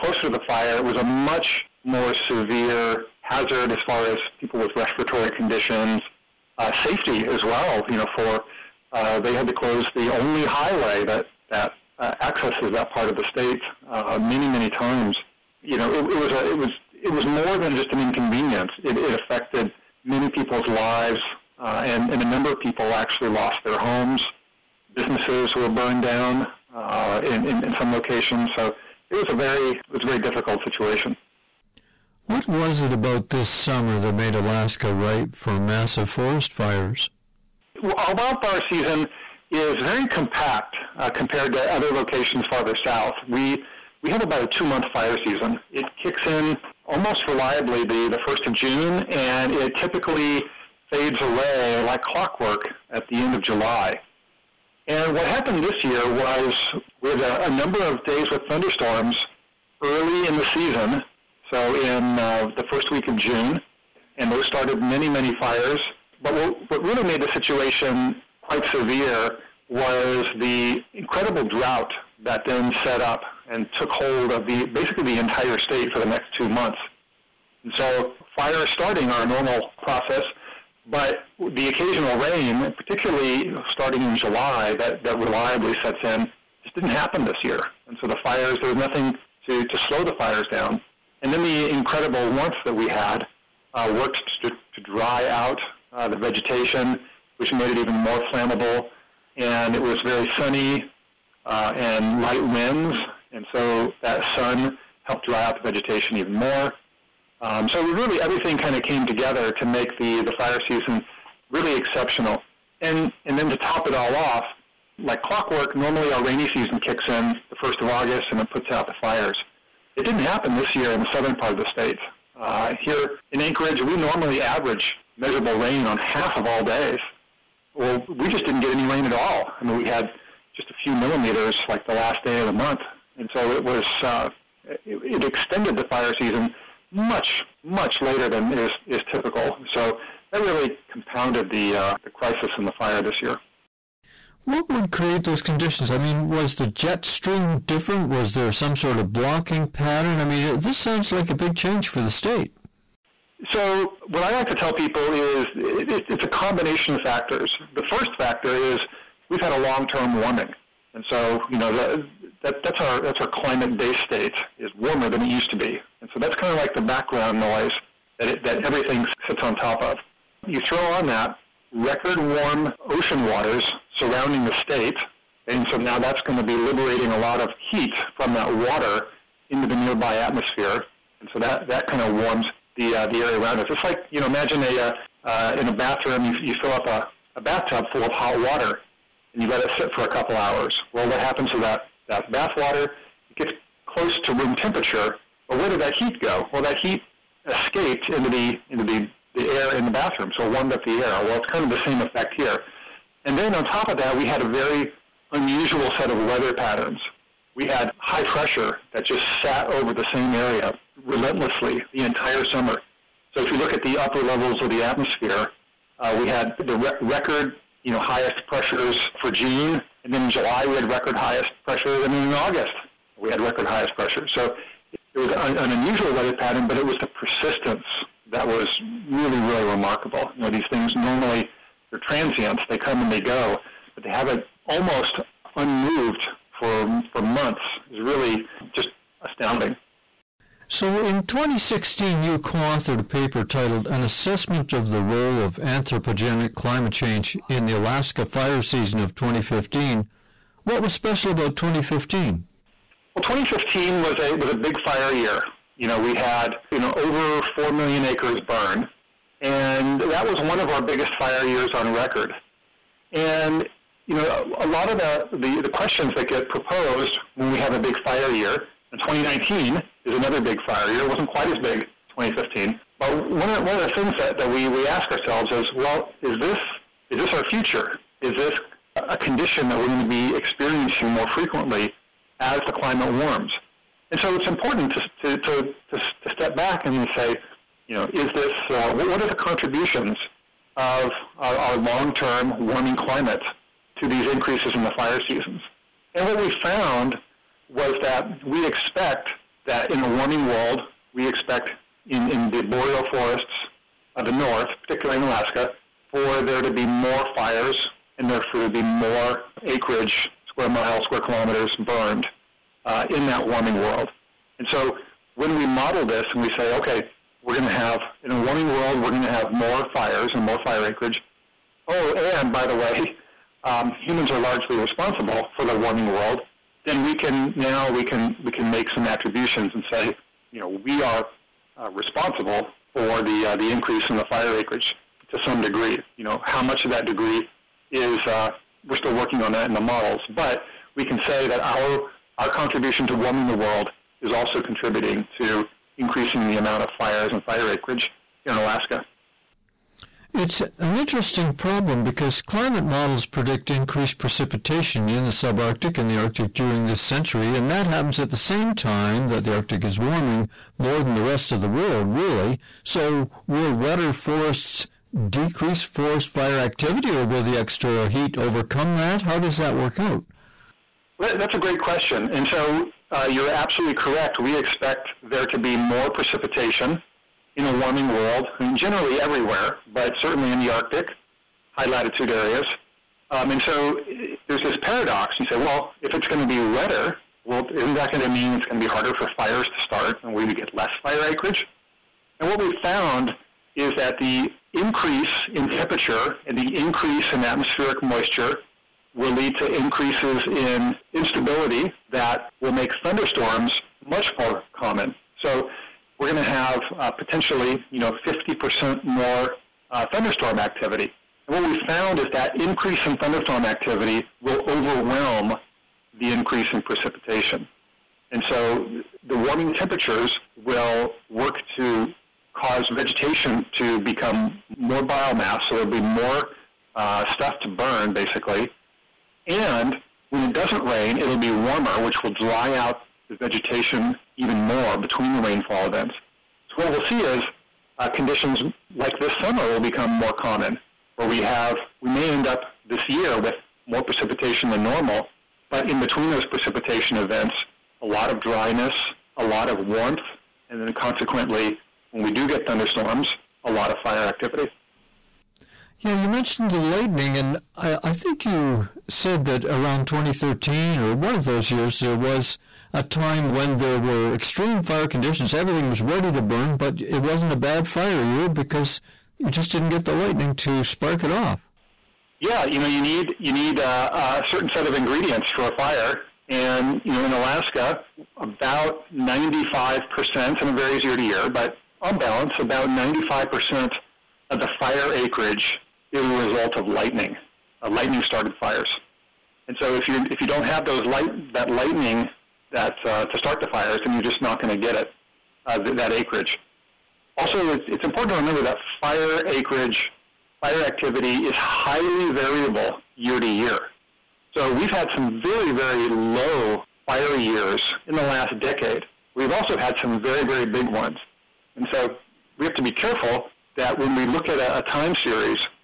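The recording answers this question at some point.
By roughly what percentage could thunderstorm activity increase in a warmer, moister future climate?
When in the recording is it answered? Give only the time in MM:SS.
06:48.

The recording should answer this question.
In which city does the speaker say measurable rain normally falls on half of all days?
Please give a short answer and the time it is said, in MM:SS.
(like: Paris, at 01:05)
Anchorage, at 02:03.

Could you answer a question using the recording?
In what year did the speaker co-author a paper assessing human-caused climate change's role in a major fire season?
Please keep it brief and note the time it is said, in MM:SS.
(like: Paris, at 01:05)
2016, at 04:01.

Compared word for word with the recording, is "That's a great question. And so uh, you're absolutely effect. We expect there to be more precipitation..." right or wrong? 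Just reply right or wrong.
wrong.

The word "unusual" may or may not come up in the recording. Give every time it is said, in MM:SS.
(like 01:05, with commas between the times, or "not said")
03:25, 03:45.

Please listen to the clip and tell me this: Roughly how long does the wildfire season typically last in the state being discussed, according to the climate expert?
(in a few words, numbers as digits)
2 months.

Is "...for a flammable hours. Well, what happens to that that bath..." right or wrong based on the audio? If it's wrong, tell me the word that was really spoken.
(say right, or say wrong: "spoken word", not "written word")
wrong: "couple", not "flammable".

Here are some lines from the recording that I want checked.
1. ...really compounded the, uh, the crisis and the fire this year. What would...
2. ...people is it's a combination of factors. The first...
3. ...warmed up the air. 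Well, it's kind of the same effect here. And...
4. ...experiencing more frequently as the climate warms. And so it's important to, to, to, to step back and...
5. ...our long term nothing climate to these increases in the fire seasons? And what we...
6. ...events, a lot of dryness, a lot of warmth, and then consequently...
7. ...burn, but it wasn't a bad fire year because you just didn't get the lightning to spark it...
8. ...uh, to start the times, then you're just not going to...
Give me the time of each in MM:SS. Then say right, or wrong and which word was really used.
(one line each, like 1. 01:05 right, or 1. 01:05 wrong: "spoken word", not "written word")
1. 02:20 right
2. 02:34 right
3. 03:20 right
4. 04:40 right
5. 04:51 wrong: "warming", not "nothing"
6. 07:27 right
7. 07:46 right
8. 08:13 wrong: "fires", not "times".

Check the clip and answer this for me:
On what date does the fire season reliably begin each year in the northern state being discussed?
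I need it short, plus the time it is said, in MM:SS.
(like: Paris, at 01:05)
first of June, at 00:48.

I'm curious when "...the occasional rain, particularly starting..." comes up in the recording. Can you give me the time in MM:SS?
01:21.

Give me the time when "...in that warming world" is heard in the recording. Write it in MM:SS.
05:13.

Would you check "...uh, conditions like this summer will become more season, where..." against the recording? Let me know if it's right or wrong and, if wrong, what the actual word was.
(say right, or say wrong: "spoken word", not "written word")
wrong: "common", not "season".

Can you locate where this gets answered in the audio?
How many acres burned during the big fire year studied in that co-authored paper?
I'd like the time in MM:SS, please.
04:16.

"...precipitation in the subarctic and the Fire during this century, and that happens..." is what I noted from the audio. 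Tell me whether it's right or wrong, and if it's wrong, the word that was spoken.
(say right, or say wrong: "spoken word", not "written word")
wrong: "Arctic", not "Fire".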